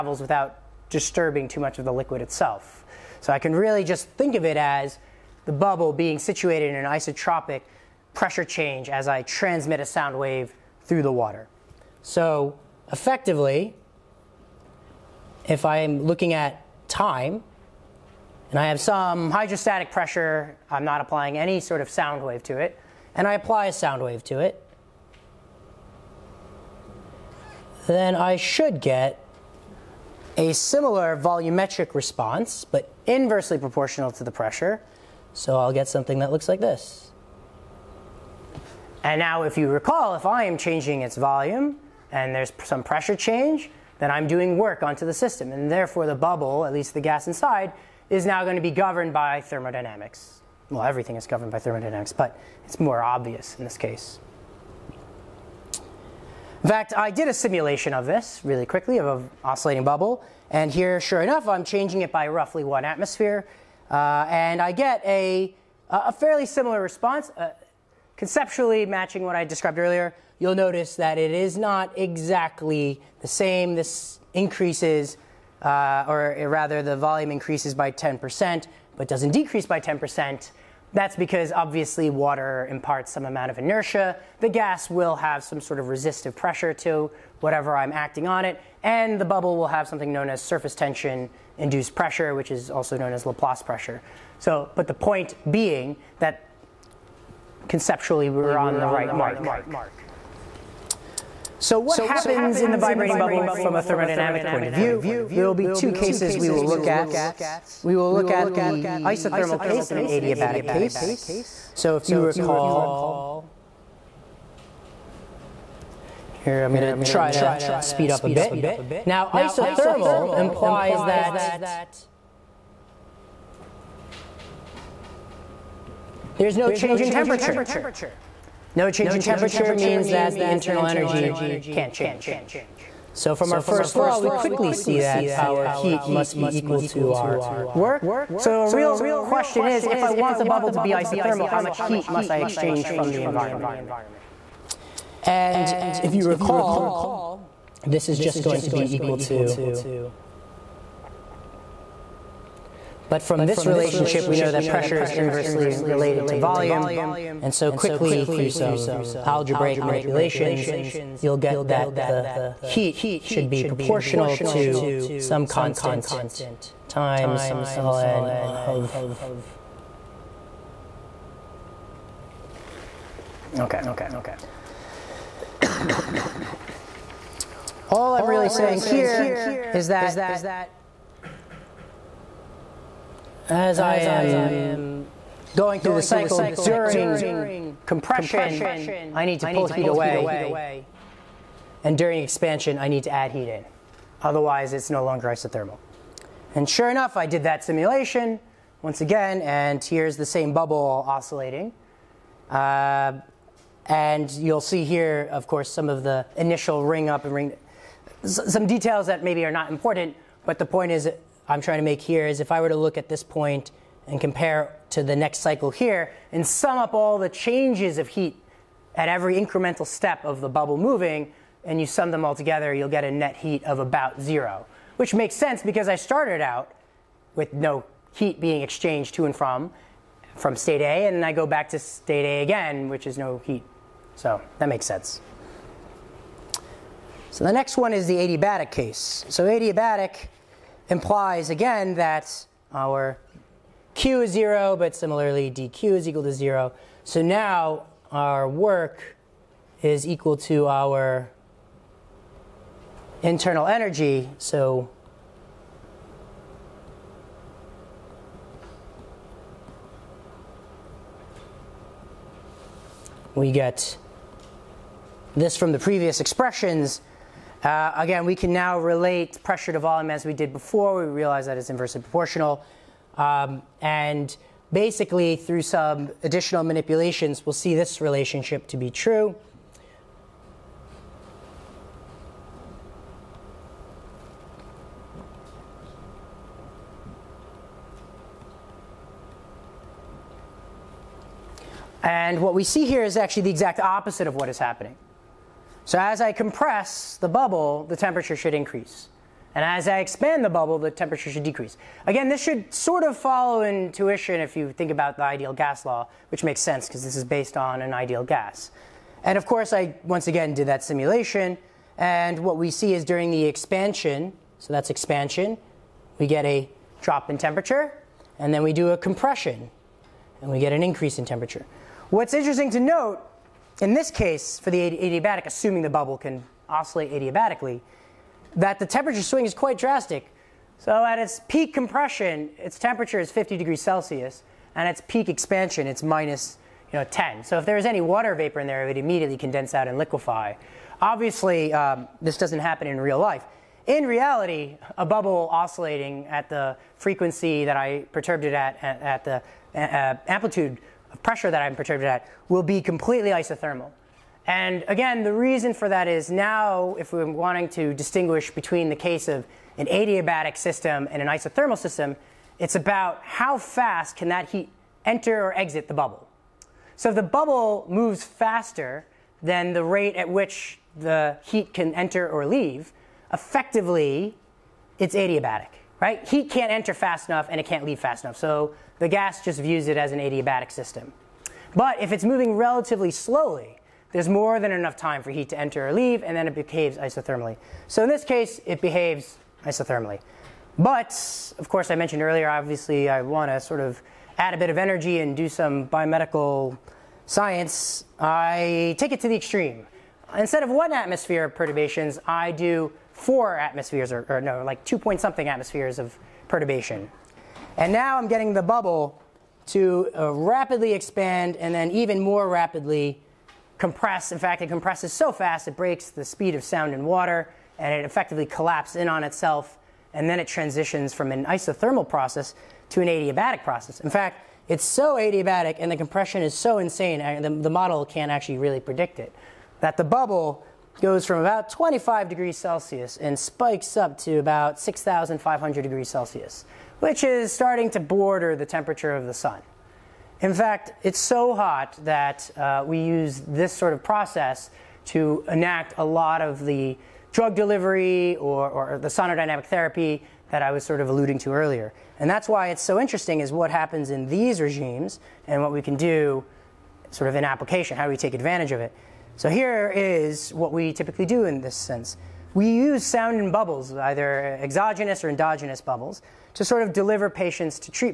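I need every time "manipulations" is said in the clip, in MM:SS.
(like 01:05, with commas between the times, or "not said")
02:39, 04:36.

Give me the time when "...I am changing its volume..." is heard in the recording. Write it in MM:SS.
00:40.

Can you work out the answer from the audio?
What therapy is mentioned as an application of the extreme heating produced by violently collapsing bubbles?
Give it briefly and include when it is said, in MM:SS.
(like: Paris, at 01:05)
sonodynamic therapy, at 07:29.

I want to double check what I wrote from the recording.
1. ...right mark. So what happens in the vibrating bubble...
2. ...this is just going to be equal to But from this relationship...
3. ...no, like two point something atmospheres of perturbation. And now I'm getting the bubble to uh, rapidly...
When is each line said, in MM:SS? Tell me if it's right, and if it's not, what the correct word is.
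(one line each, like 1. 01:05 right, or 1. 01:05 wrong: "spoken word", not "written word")
1. 01:38 right
2. 02:27 right
3. 06:44 right.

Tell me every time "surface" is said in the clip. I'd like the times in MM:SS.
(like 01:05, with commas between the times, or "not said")
01:30.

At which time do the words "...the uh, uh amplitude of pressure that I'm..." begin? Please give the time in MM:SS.
05:49.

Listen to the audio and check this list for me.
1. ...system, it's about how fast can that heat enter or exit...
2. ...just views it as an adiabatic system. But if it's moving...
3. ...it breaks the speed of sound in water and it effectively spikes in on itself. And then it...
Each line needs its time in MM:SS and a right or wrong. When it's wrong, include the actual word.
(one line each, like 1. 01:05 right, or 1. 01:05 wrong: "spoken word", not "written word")
1. 06:01 right
2. 06:19 right
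3. 06:55 wrong: "collapses", not "spikes".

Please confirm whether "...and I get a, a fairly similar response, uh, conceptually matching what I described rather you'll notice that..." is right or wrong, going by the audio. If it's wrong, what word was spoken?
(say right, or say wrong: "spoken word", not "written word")
wrong: "earlier", not "rather".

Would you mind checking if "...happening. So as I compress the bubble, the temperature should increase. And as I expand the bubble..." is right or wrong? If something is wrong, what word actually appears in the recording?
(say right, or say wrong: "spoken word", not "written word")
right.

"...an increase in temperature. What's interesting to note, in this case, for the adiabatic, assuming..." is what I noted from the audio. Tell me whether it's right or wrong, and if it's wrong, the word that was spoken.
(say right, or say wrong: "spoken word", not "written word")
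right.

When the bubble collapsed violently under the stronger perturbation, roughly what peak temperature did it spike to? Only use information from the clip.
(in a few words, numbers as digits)
6,500 degrees Celsius.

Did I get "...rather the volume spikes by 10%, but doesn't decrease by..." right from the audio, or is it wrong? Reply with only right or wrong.
wrong.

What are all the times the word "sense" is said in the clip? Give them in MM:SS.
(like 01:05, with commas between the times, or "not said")
03:45, 03:54, 05:06, 07:41.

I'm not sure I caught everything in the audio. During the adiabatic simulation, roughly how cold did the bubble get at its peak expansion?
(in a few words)
-10 degrees.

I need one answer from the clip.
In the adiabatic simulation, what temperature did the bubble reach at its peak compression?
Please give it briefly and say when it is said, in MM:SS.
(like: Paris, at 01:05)
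50 degrees Celsius, at 05:33.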